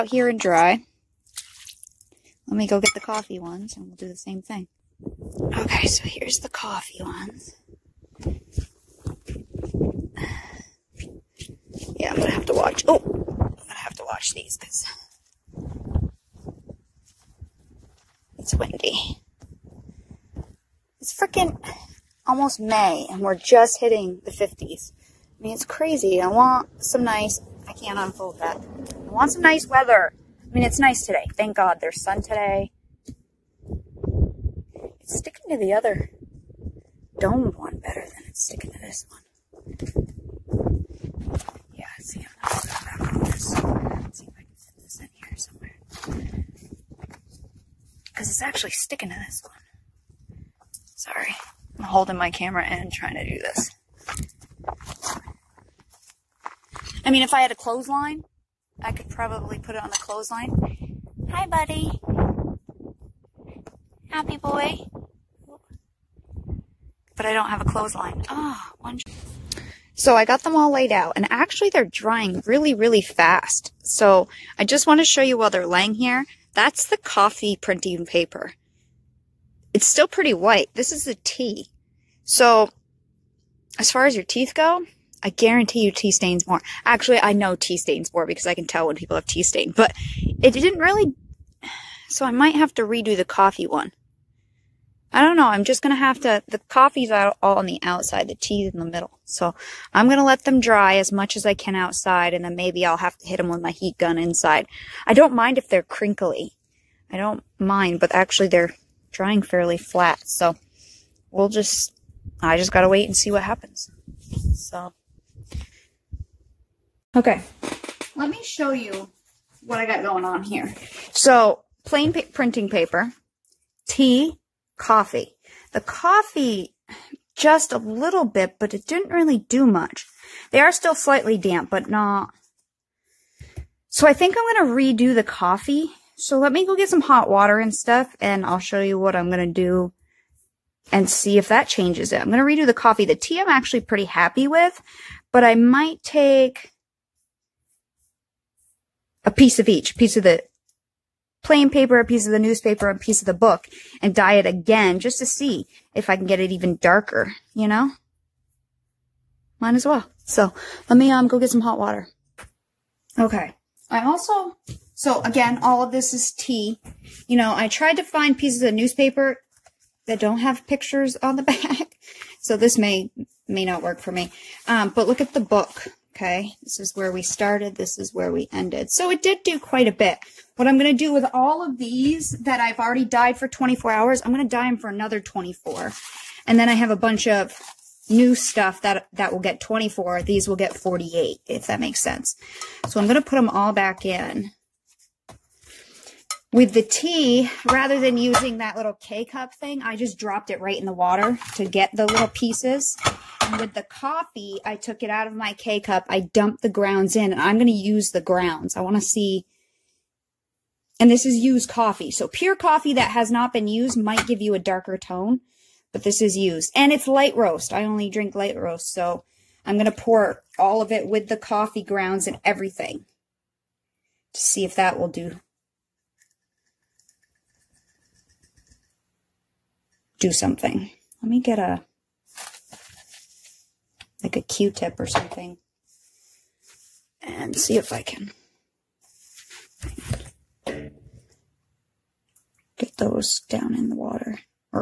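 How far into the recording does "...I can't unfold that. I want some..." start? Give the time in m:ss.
0:27.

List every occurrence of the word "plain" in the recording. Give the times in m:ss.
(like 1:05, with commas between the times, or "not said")
2:01, 2:31.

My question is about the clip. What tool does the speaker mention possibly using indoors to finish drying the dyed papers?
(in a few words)
heat gun.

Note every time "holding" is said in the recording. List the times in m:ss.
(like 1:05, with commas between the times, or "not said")
0:51.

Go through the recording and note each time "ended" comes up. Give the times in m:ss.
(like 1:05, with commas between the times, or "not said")
2:58.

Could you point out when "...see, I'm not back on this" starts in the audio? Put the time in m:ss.
0:41.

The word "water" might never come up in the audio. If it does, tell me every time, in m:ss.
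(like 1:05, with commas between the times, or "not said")
2:17, 2:41, 3:20, 4:03.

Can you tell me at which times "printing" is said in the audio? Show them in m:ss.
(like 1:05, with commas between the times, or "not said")
1:17, 2:02.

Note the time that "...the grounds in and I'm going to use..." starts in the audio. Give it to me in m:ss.
3:26.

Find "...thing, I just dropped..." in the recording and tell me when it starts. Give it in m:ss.
3:19.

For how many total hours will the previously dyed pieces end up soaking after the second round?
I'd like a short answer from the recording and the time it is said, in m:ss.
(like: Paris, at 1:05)
48, at 3:10.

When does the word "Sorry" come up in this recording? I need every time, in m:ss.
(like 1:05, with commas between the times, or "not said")
0:50.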